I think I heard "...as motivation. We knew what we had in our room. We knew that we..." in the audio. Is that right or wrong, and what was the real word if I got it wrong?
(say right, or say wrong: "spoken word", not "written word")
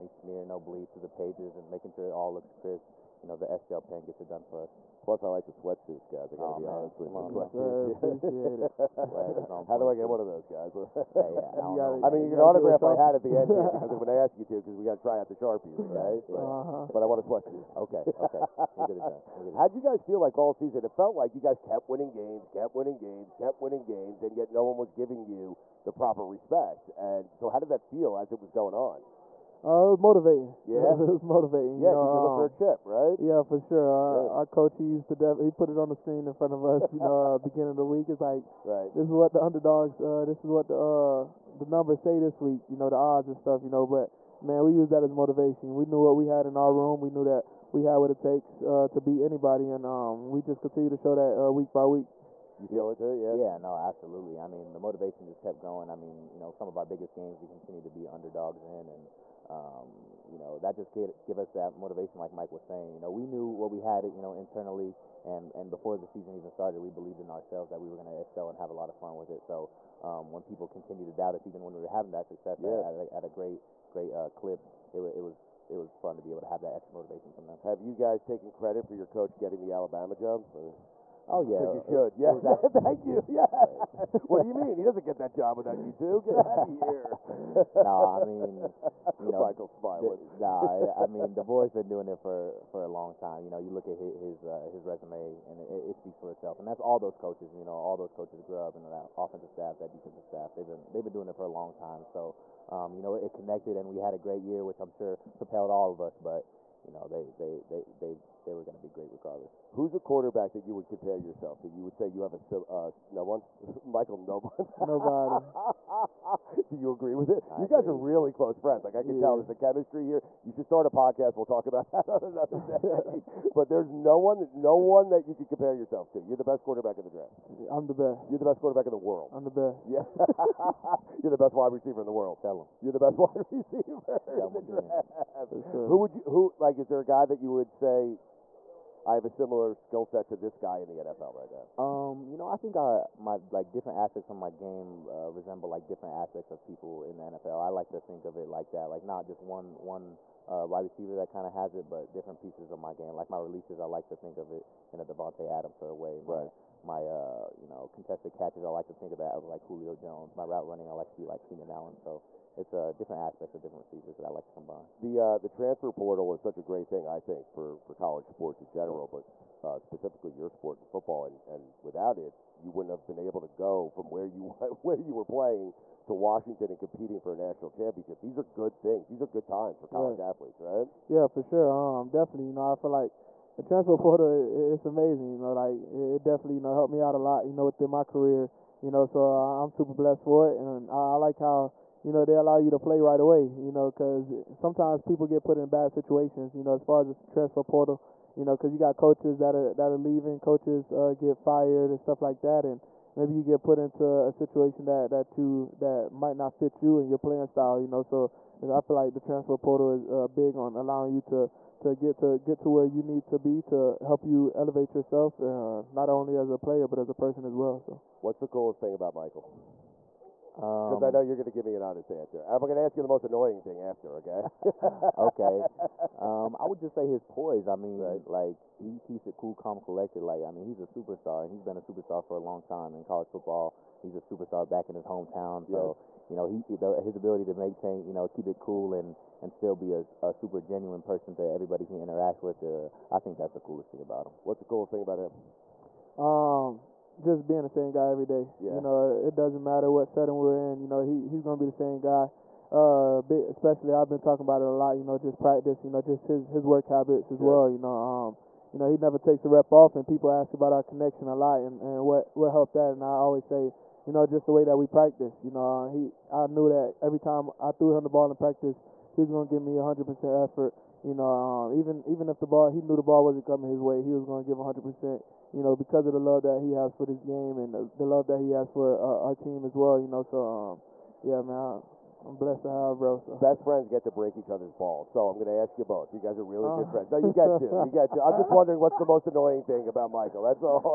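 right.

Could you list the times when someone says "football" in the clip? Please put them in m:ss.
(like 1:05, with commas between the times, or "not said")
2:50, 3:53.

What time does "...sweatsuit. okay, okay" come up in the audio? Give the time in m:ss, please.
0:17.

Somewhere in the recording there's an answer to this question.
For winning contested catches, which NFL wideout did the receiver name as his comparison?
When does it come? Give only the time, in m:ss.
2:39.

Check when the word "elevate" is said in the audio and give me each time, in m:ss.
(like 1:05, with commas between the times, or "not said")
3:34.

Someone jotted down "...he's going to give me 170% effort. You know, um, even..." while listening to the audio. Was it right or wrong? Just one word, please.
wrong.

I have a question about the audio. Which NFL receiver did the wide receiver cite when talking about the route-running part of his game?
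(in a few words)
Keenan Allen.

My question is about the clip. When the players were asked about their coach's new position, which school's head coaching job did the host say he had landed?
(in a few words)
Alabama.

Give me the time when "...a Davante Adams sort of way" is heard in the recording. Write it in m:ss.
2:34.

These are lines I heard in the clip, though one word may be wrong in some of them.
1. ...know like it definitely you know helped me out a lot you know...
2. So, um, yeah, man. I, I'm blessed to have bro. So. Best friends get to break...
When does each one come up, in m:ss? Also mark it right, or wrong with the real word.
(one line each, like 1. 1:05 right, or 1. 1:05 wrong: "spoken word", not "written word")
1. 3:05 right
2. 4:40 right.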